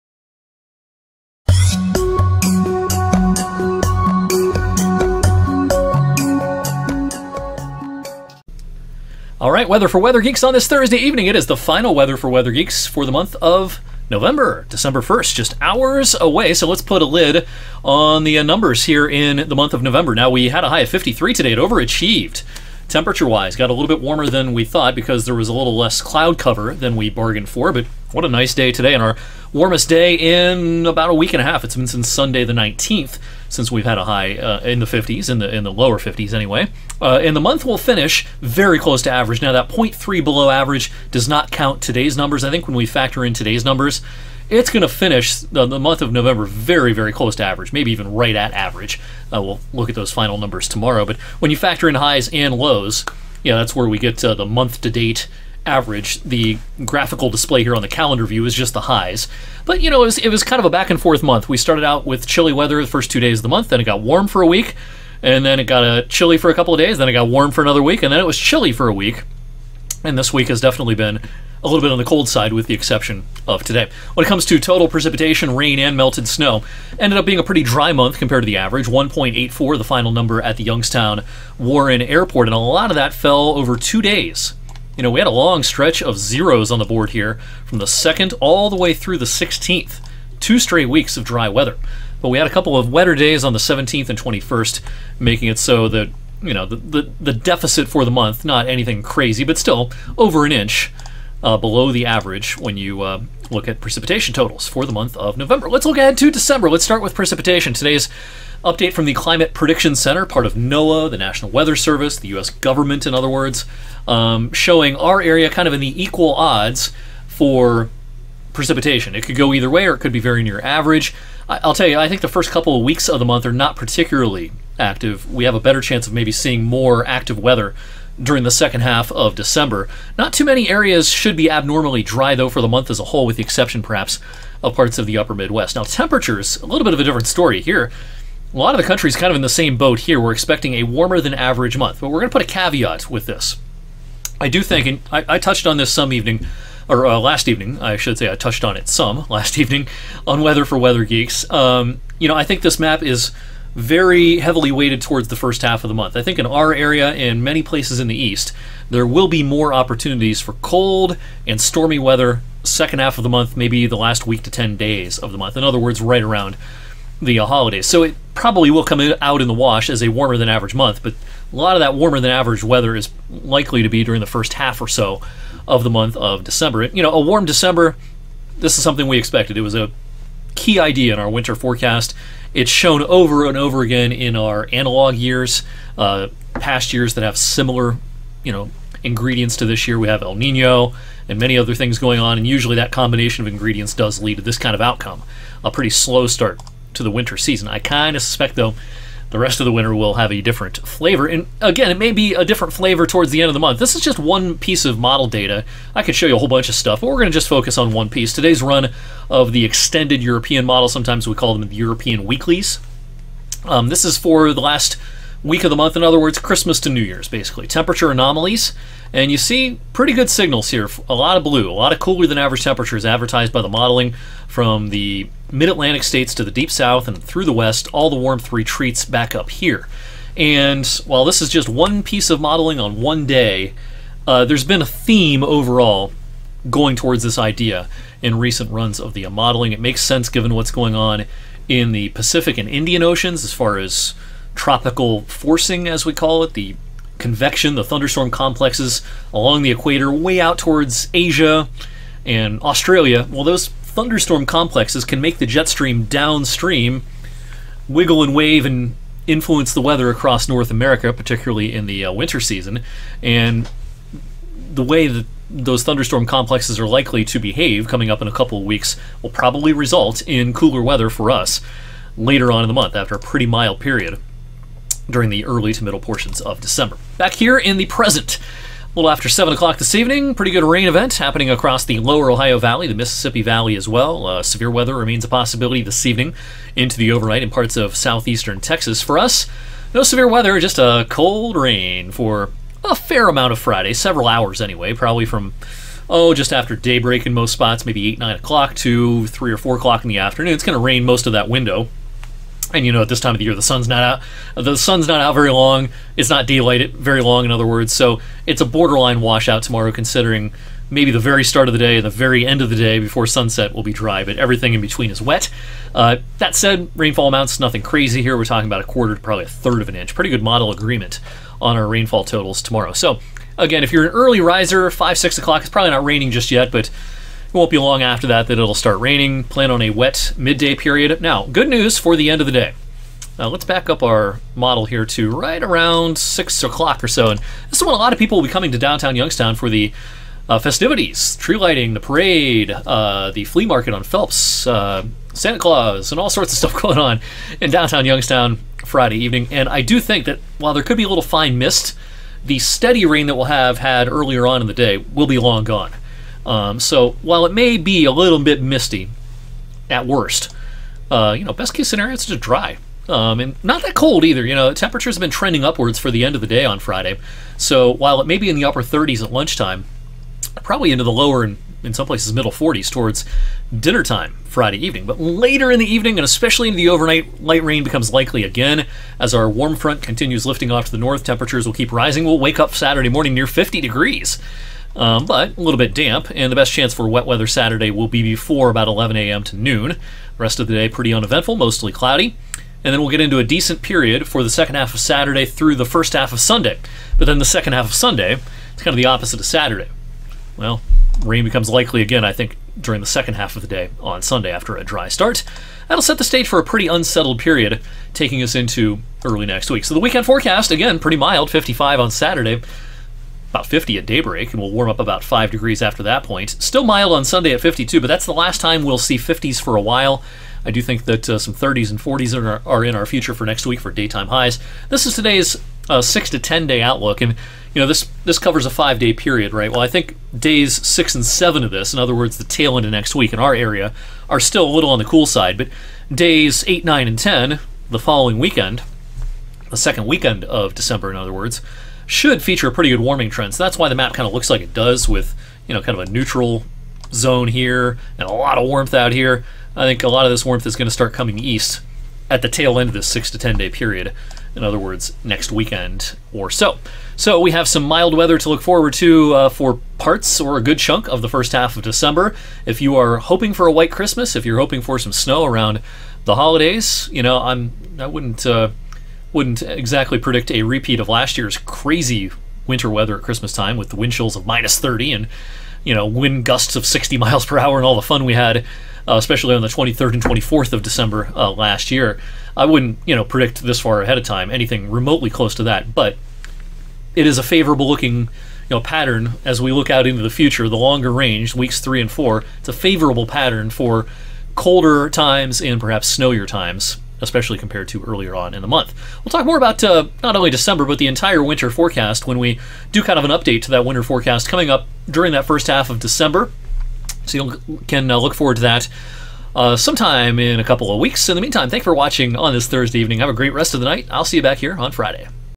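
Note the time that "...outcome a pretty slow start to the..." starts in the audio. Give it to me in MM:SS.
03:14.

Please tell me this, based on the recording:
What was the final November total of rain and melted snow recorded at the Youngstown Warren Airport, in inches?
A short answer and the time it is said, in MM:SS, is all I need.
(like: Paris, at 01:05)
1.84, at 01:18.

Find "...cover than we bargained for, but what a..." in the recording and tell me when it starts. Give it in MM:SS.
00:26.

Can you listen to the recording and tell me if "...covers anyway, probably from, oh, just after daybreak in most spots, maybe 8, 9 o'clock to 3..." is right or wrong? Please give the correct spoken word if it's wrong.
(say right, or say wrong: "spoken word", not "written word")
wrong: "hours", not "covers".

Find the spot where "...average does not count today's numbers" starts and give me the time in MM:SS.
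00:40.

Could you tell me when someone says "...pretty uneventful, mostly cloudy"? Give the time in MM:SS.
06:30.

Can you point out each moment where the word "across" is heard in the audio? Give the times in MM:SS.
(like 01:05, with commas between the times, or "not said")
04:20, 04:41.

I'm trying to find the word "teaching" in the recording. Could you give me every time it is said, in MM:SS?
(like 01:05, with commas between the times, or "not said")
not said.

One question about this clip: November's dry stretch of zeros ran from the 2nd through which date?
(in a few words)
16th.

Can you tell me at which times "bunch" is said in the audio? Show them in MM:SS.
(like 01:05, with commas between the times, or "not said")
03:26.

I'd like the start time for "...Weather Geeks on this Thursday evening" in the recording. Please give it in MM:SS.
00:09.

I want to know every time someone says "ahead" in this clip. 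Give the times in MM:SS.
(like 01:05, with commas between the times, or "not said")
01:45, 08:04.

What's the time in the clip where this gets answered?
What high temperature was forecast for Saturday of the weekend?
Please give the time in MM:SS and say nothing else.
06:51.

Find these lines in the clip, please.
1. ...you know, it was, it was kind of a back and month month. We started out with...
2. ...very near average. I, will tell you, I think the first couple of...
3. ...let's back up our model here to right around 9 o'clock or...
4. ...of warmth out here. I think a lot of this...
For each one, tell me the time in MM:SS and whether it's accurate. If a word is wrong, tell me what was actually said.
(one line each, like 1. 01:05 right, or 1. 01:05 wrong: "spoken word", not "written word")
1. 00:59 wrong: "forth", not "month"
2. 02:00 right
3. 05:33 wrong: "6", not "9"
4. 07:28 right.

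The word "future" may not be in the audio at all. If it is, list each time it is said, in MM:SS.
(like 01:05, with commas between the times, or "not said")
07:03, 08:10.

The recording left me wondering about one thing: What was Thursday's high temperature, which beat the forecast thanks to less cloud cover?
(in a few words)
53.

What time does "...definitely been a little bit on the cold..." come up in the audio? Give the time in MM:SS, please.
01:10.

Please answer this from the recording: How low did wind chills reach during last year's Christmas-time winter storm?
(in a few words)
minus 30.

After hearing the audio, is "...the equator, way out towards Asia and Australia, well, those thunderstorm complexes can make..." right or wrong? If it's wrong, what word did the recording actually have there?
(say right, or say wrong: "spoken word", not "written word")
right.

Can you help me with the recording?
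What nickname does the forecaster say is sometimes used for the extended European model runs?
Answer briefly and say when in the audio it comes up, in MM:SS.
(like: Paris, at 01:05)
European weeklies, at 03:31.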